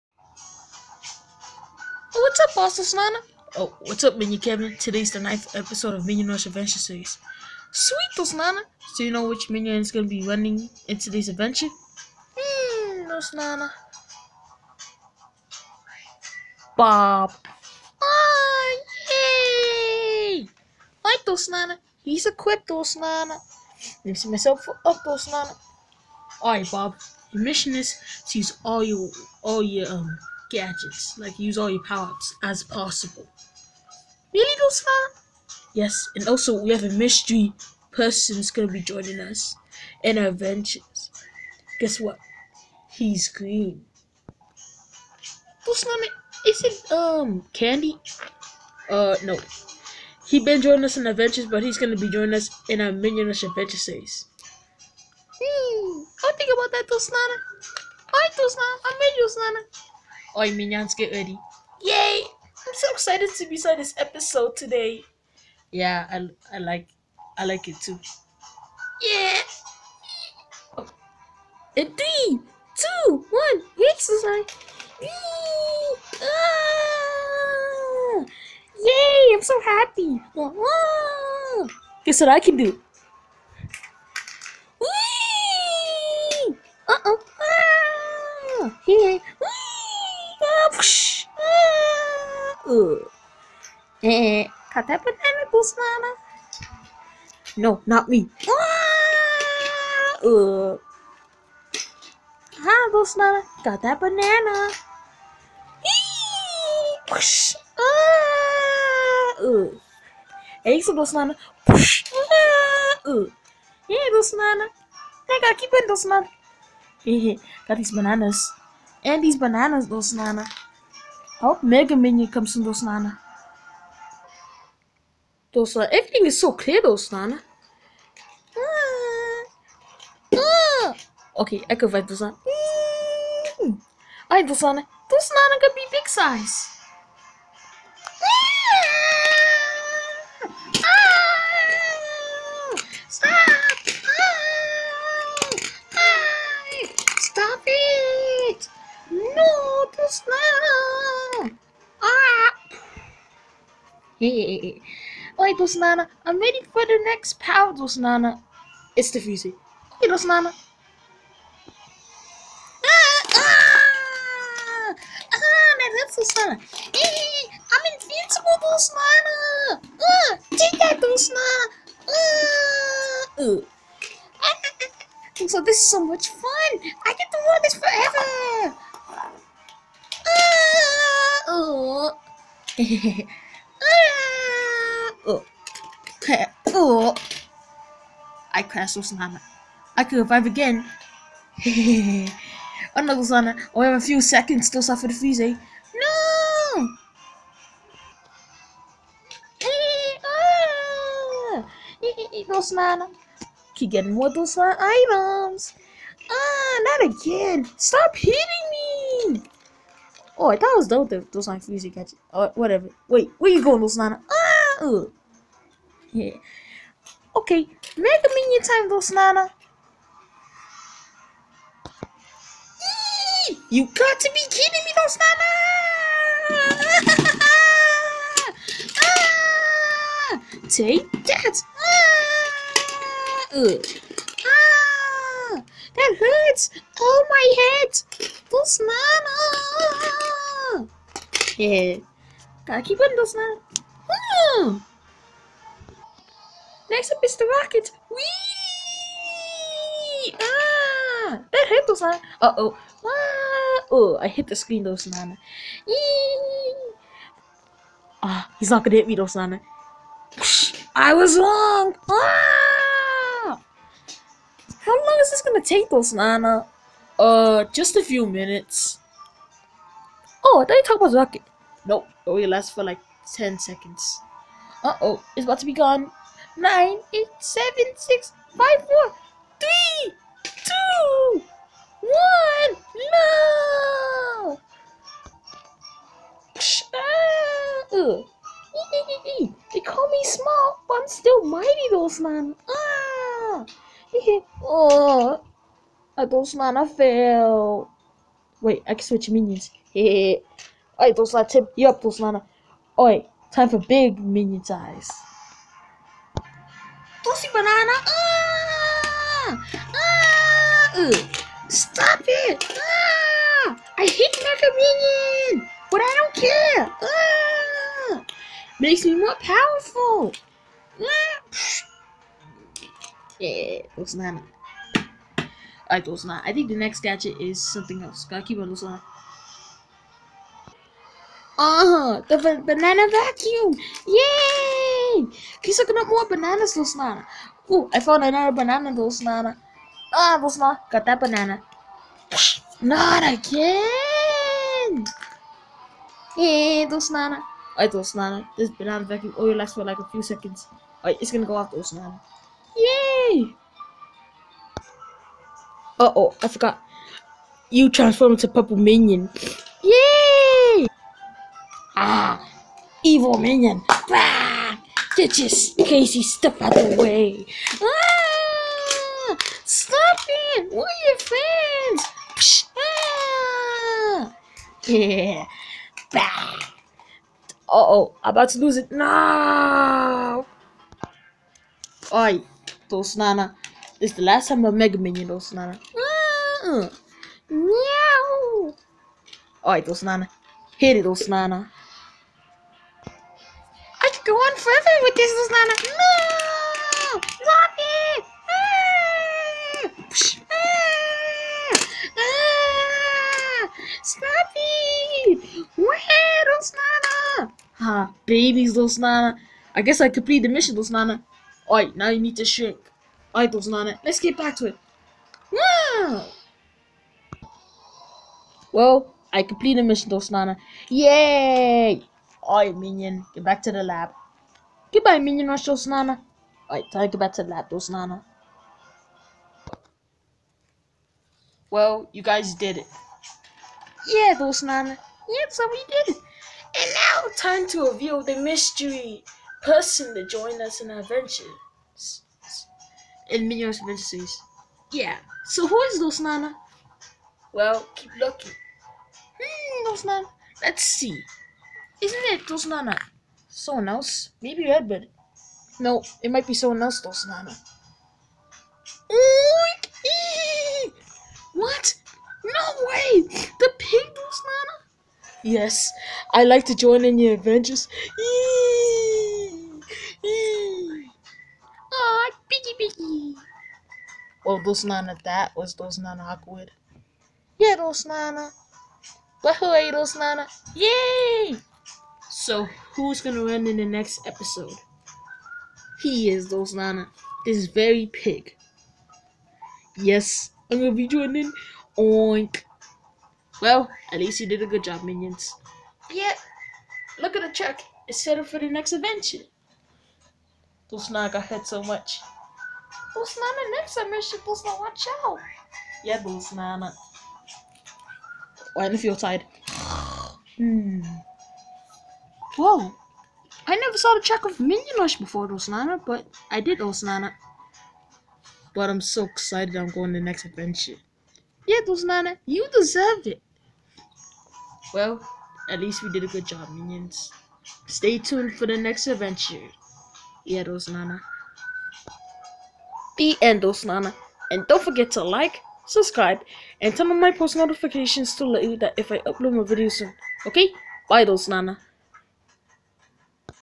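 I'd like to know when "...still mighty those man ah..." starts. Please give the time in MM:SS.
04:51.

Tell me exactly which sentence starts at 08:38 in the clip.
But I'm so excited I'm going to the next adventure.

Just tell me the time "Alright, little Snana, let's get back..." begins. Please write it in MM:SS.
06:53.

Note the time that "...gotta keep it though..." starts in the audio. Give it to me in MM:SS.
04:02.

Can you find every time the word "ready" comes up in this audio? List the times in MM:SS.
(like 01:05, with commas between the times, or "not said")
01:01, 02:36.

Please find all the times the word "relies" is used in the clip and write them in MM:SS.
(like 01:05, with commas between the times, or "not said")
not said.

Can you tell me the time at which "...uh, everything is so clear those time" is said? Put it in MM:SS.
02:05.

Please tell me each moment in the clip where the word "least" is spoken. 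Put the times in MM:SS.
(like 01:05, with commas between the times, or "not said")
08:14, 08:45.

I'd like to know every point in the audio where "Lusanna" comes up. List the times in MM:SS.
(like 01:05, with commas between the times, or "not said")
03:33.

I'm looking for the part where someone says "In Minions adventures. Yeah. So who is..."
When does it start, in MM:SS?
07:23.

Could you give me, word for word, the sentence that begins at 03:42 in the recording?
Eee, you got to be kidding me though, Snana!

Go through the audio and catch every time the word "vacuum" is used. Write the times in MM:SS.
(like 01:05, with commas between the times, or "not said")
05:33, 05:49.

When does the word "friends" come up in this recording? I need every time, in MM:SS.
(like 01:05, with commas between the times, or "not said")
06:11.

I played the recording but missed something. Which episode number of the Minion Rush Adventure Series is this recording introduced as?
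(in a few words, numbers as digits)
9th.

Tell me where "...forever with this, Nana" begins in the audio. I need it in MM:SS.
06:34.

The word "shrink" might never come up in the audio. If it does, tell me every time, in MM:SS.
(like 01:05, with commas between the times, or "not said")
06:52.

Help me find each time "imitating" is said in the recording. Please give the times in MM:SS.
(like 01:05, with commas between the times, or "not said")
not said.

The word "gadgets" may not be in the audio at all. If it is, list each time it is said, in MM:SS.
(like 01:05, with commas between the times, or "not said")
00:30, 05:27.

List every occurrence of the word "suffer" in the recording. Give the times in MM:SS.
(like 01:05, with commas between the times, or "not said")
03:14.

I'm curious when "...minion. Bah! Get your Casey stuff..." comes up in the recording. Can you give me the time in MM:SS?
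06:03.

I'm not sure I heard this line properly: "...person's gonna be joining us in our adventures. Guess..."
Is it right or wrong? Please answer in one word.
right.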